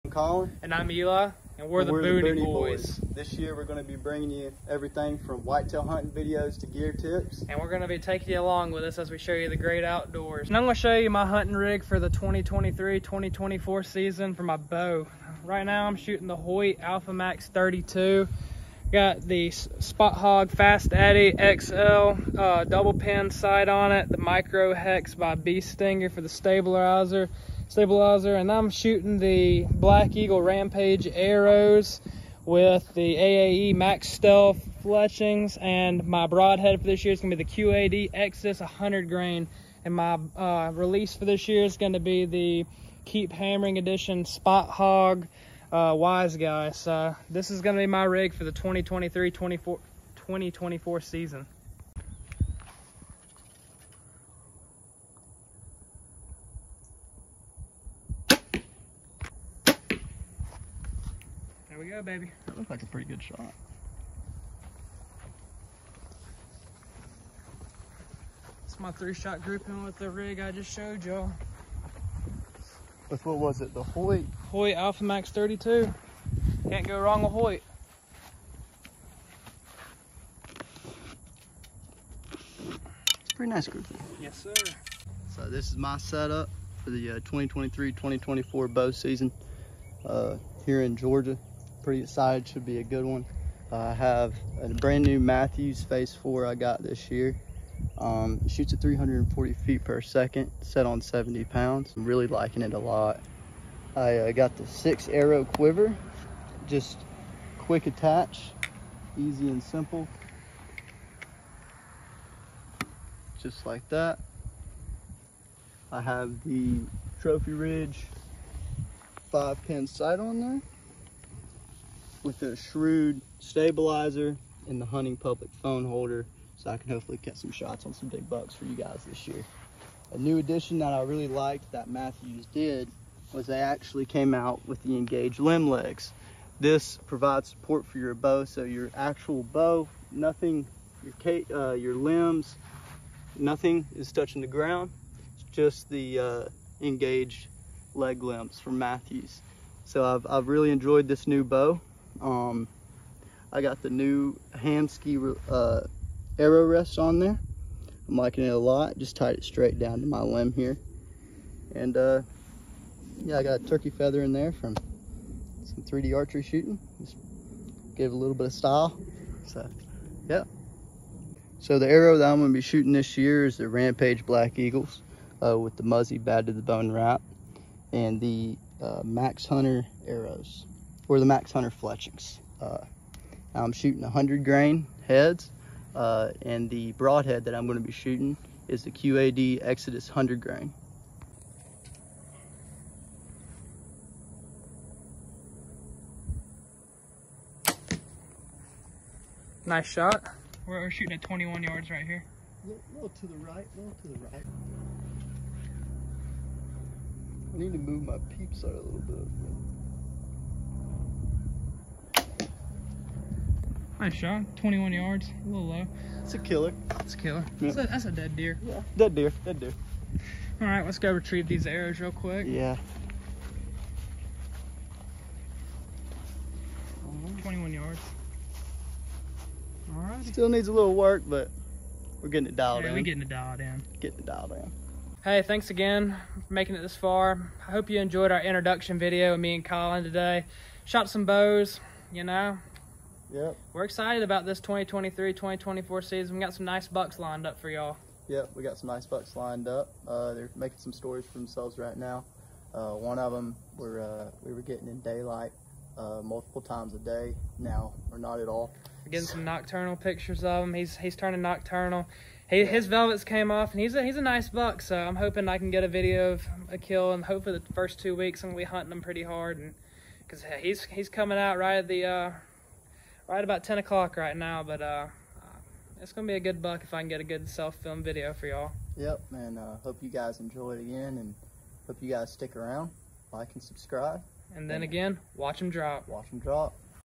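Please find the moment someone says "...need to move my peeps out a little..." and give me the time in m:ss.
3:27.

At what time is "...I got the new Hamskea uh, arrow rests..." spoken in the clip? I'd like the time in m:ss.
2:33.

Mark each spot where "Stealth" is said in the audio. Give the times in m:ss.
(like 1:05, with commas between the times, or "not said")
0:34.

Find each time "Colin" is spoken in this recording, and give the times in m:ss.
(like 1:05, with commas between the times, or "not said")
0:00, 3:59.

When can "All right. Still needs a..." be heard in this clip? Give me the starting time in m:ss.
3:49.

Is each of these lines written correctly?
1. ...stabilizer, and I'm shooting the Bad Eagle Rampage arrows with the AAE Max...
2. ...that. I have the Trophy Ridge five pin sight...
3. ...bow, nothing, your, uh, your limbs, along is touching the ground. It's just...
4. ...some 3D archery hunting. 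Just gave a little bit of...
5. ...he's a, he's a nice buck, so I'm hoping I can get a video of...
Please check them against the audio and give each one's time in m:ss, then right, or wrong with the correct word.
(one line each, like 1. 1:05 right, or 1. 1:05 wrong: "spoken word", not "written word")
1. 0:27 wrong: "Black", not "Bad"
2. 1:53 right
3. 2:19 wrong: "nothing", not "along"
4. 2:45 wrong: "shooting", not "hunting"
5. 4:23 right.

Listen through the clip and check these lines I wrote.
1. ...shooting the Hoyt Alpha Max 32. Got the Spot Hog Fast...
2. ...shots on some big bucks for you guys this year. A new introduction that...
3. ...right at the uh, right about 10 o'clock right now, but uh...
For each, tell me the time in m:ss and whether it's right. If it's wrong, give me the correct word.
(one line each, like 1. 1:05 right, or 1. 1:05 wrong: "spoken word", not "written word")
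1. 0:15 right
2. 2:07 wrong: "addition", not "introduction"
3. 4:31 right.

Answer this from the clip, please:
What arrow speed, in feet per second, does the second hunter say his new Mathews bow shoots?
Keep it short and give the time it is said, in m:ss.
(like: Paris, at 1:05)
340, at 1:38.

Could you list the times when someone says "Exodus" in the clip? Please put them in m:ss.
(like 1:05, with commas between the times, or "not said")
0:38, 3:09.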